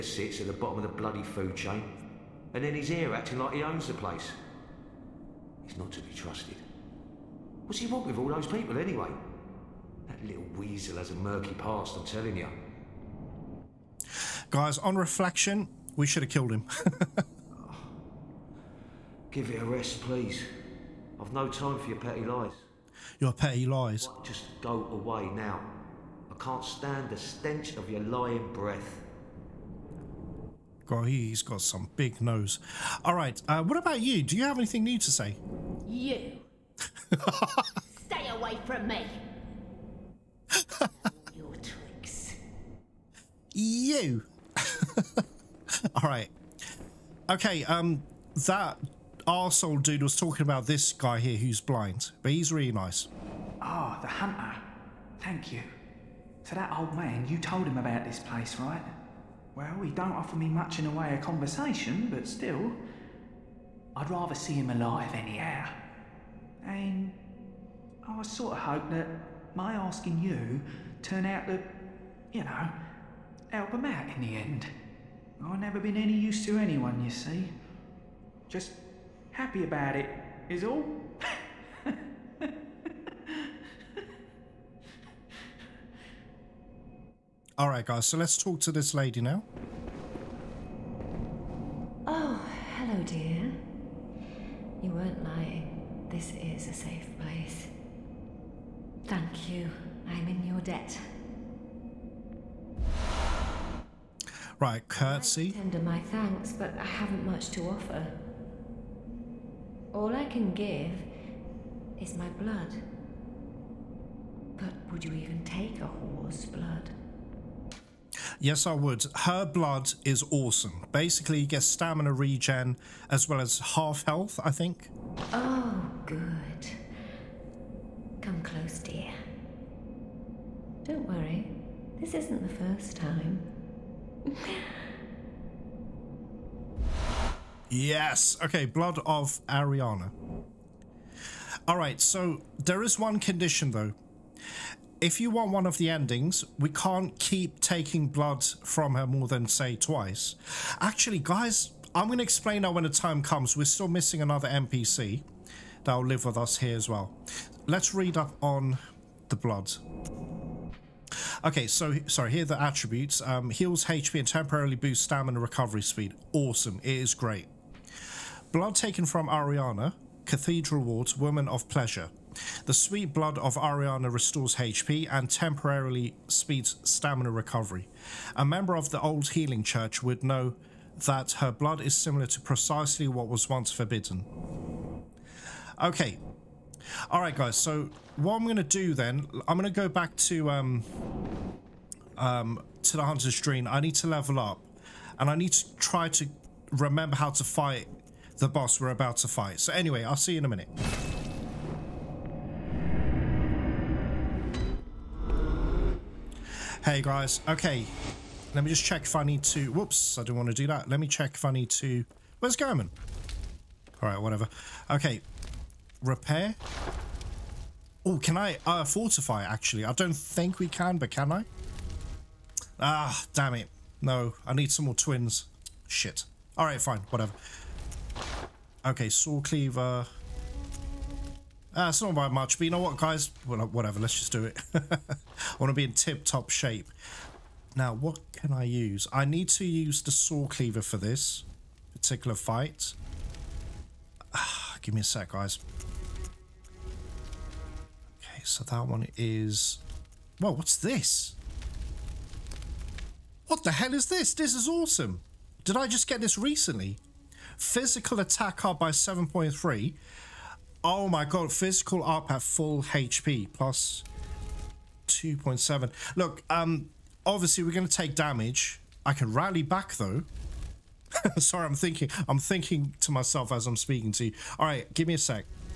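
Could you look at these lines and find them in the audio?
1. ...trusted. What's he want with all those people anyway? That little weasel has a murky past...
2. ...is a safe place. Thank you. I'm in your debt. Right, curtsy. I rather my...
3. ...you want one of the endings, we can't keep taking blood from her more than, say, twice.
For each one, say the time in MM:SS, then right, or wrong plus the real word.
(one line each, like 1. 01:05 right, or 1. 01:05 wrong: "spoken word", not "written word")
1. 00:06 right
2. 01:36 wrong: "tender", not "rather"
3. 02:25 right.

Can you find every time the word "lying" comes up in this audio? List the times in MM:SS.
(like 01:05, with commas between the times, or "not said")
00:28, 01:35.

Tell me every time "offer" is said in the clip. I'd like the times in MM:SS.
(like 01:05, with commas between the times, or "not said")
01:00, 01:47.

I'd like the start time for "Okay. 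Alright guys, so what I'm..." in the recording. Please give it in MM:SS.
03:05.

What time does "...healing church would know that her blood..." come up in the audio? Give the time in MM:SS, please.
02:59.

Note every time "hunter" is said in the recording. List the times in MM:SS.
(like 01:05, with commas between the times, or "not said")
00:54, 03:13.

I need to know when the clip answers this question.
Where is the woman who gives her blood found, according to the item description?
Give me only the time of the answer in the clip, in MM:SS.
02:50.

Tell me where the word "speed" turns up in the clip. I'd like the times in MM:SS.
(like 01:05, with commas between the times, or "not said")
02:45, 02:56.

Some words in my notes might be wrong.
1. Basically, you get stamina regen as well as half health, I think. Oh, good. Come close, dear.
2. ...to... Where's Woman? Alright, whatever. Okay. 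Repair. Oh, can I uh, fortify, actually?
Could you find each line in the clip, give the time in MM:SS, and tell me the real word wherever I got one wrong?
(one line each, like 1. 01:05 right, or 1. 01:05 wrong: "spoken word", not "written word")
1. 02:00 right
2. 03:31 wrong: "Gehrman", not "Woman".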